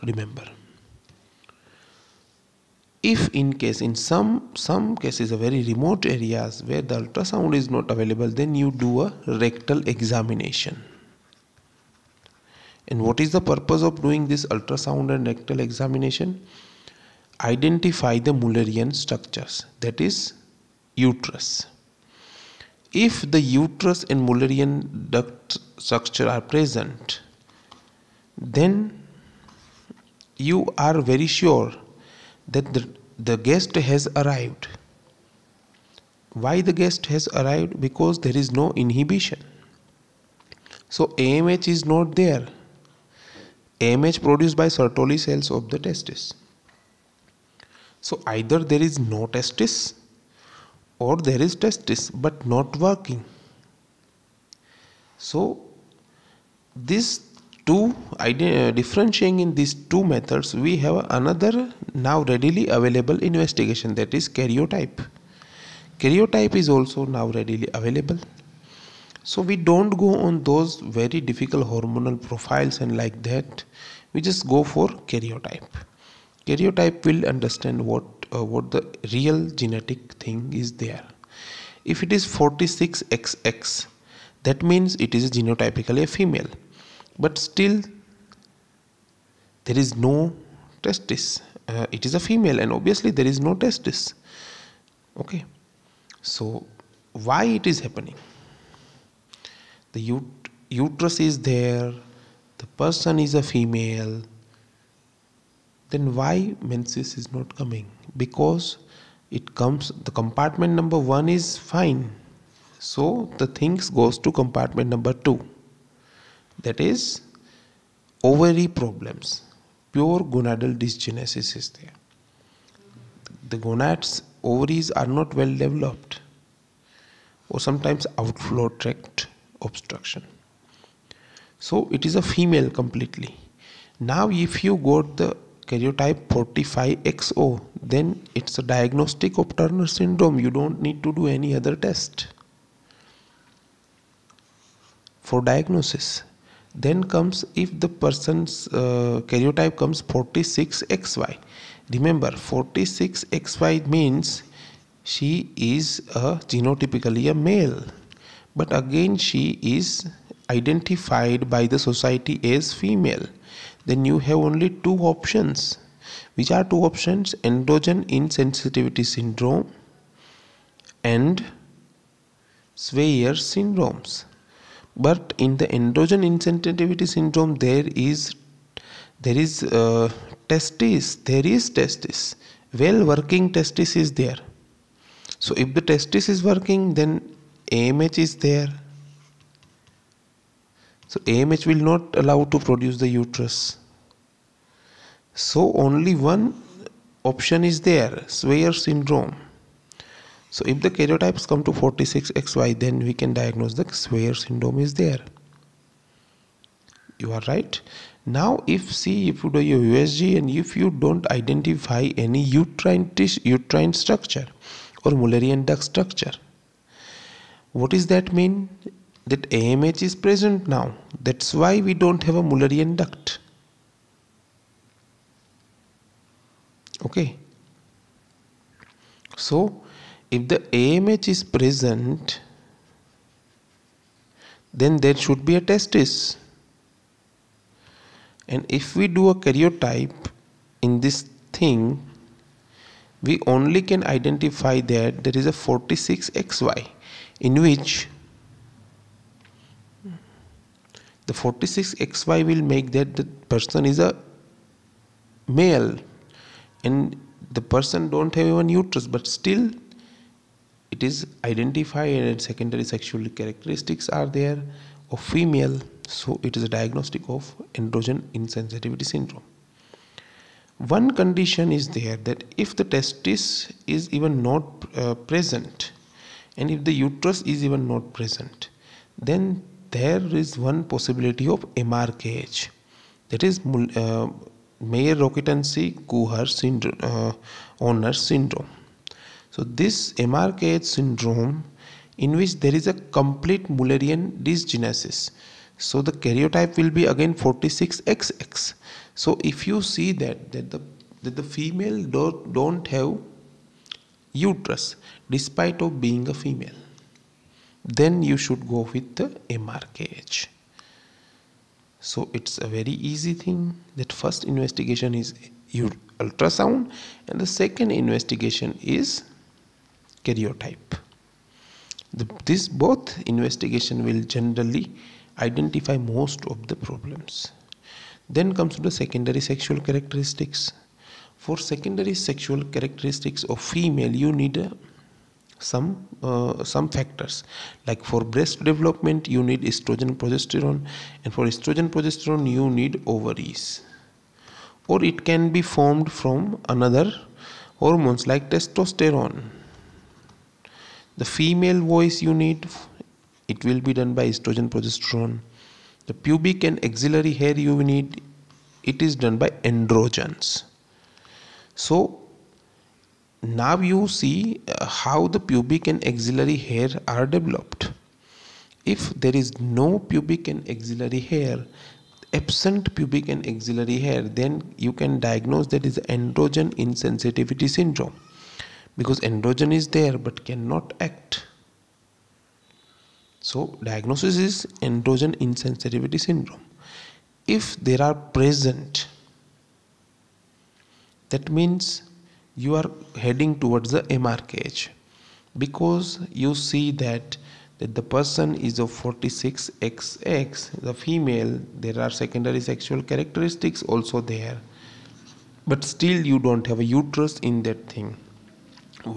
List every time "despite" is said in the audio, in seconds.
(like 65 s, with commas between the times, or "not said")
305 s.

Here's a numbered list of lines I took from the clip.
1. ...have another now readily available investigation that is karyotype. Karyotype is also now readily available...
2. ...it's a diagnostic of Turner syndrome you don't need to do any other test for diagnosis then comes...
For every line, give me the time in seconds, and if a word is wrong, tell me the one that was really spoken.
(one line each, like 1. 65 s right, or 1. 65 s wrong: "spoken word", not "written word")
1. 60 s right
2. 138 s right.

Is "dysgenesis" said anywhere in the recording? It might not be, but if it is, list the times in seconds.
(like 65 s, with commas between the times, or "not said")
120 s, 294 s.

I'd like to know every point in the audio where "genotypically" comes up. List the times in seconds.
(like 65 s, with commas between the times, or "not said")
85 s, 156 s.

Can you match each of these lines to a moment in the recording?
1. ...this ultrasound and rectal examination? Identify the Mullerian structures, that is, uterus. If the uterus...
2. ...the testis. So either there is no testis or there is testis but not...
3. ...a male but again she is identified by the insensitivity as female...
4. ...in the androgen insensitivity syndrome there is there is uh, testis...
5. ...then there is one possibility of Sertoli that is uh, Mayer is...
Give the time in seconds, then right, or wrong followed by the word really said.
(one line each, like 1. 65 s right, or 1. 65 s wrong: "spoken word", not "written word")
1. 14 s right
2. 45 s right
3. 157 s wrong: "society", not "insensitivity"
4. 175 s right
5. 279 s wrong: "MRKH", not "Sertoli".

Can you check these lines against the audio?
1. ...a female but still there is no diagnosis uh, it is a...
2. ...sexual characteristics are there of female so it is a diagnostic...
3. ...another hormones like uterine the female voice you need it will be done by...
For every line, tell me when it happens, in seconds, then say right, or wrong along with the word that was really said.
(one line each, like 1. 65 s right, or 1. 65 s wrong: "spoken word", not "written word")
1. 86 s wrong: "testis", not "diagnosis"
2. 262 s right
3. 346 s wrong: "testosterone", not "uterine".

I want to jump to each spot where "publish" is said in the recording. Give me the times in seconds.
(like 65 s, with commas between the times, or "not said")
not said.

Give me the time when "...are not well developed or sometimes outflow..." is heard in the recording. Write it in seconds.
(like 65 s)
124 s.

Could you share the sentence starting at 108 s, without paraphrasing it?
Because it comes, the compartment number one is fine.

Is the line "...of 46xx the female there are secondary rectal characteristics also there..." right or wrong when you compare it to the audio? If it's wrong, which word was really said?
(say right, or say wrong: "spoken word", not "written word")
wrong: "sexual", not "rectal".